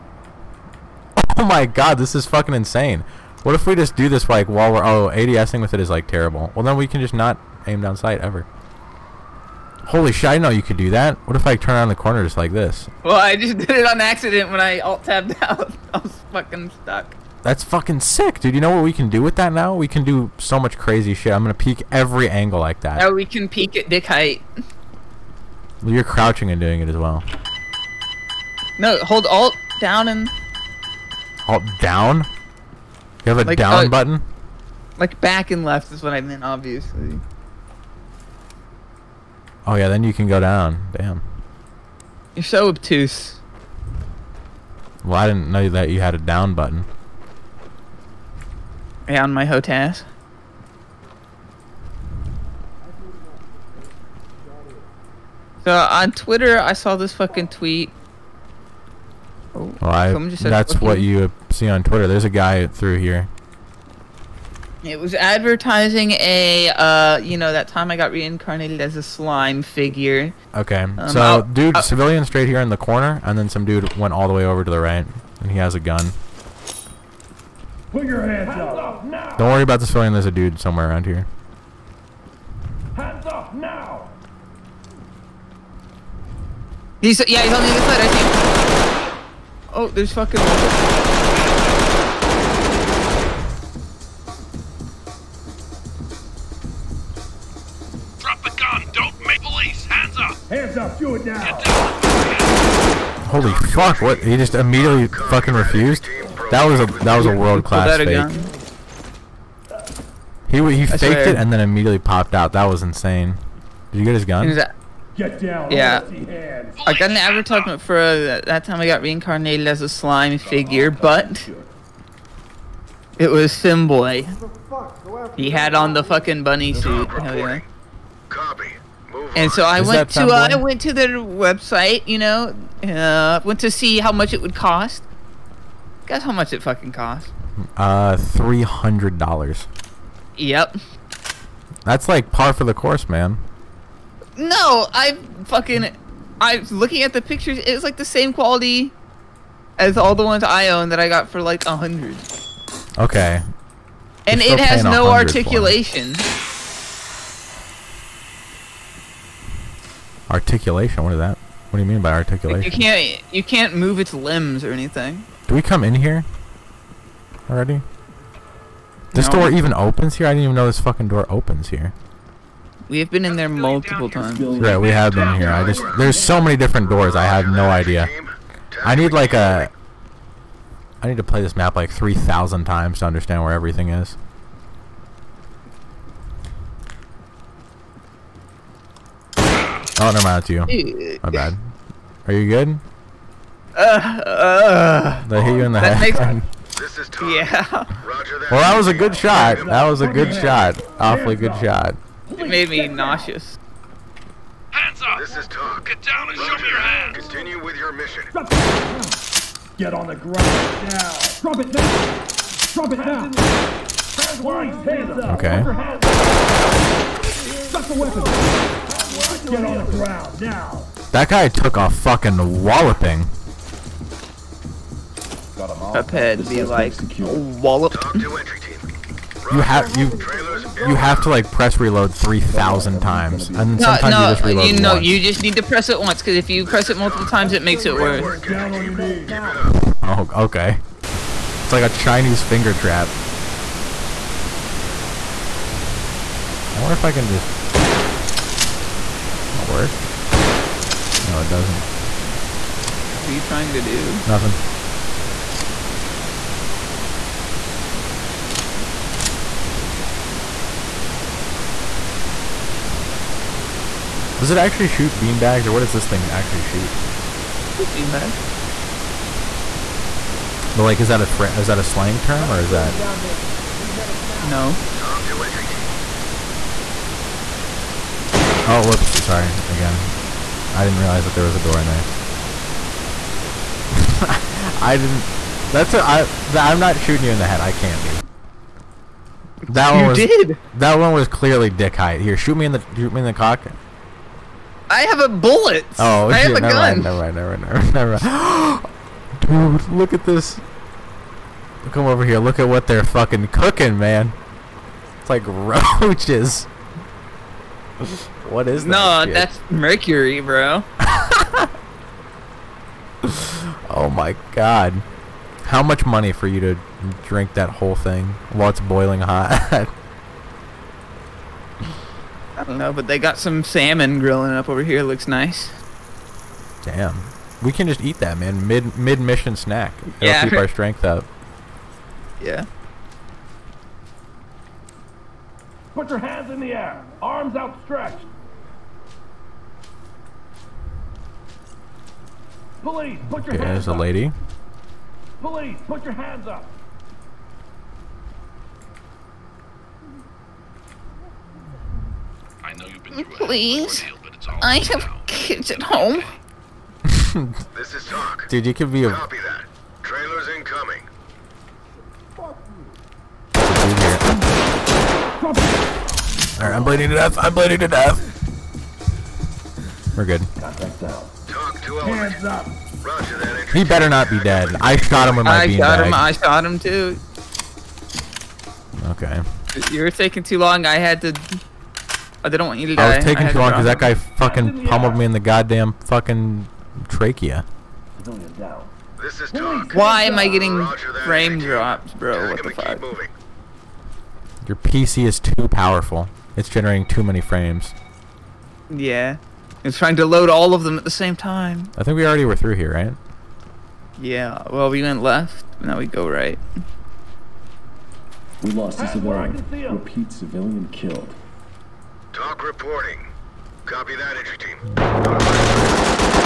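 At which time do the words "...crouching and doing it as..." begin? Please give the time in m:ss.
0:26.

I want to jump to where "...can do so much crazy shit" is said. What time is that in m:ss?
0:19.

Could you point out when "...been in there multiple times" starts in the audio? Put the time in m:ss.
2:53.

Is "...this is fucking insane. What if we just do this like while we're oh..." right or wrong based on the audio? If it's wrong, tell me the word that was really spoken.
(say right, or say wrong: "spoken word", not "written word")
right.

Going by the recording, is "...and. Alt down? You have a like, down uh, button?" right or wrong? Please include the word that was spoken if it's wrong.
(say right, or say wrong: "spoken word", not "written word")
right.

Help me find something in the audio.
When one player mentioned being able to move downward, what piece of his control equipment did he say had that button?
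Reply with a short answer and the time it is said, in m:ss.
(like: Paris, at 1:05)
HOTAS, at 0:49.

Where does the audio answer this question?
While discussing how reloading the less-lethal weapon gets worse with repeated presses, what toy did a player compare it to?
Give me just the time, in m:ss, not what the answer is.
4:01.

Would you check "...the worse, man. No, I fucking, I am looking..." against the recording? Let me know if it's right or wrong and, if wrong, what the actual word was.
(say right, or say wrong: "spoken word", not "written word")
wrong: "course", not "worse".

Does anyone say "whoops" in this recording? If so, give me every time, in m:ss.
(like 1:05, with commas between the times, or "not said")
4:38.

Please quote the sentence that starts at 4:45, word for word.
That's i I, I'm not shooting you in the head.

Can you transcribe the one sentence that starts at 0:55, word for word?
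So on Twitter, I saw this fucking tweet.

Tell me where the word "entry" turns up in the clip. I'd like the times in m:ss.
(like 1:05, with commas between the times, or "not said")
4:35, 6:54.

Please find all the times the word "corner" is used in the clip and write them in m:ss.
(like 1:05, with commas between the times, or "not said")
0:11, 1:12.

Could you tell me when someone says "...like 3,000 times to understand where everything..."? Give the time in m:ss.
3:01.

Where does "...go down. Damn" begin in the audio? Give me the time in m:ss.
0:40.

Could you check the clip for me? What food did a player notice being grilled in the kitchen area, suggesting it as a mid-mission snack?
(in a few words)
Salmon.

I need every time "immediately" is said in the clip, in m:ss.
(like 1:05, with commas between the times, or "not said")
1:44, 1:51.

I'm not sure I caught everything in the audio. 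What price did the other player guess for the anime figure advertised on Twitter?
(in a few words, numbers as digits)
$300.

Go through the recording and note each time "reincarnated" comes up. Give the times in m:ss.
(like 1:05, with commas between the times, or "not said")
1:08, 1:59.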